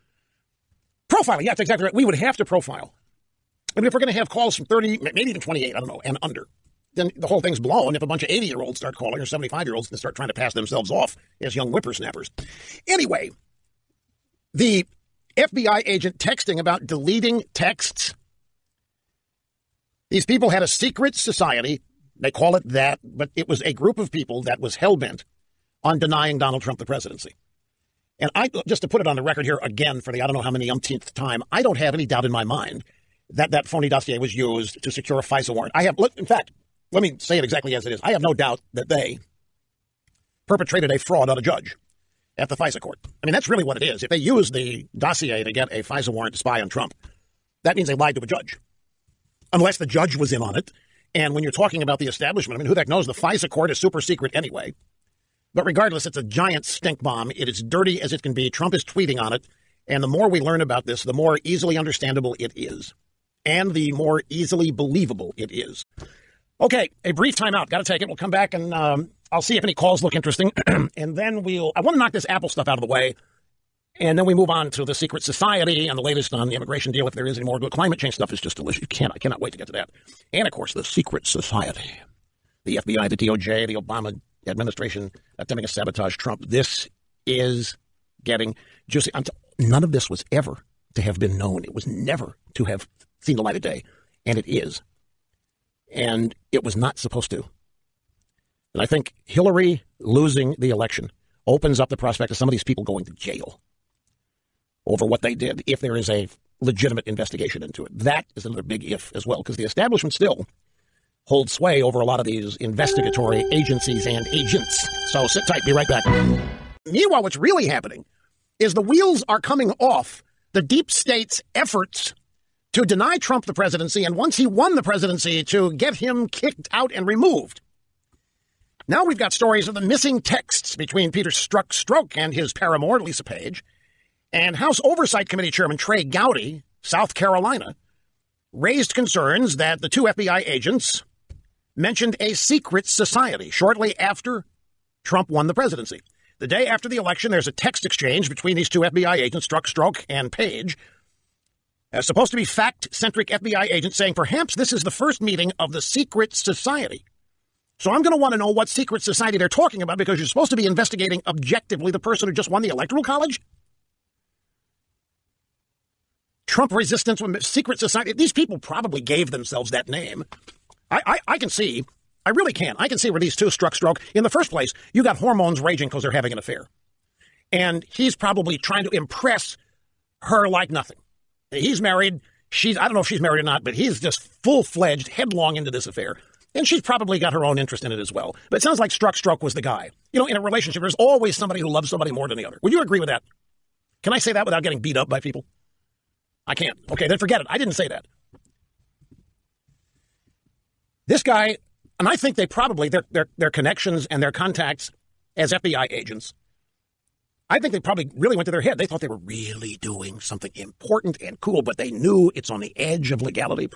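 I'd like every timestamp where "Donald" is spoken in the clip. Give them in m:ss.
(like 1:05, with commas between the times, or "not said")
0:26.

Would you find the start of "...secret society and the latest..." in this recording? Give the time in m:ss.
1:14.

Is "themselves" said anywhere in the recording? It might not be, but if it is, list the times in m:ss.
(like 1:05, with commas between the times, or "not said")
0:10, 2:49.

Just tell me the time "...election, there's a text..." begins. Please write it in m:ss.
2:26.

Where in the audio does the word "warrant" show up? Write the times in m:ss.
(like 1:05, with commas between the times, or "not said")
0:35, 0:46.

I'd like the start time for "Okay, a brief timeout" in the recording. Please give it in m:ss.
1:06.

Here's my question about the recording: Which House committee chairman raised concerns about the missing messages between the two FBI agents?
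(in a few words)
Trey Gowdy.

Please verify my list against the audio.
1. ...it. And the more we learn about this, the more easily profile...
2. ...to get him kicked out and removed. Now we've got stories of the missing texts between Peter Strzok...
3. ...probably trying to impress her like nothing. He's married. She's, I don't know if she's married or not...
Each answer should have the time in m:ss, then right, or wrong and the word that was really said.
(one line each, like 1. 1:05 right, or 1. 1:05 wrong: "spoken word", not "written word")
1. 0:59 wrong: "understandable", not "profile"
2. 2:05 right
3. 2:58 right.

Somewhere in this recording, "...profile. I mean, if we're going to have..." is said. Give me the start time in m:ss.
0:02.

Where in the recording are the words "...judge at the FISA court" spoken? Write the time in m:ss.
0:41.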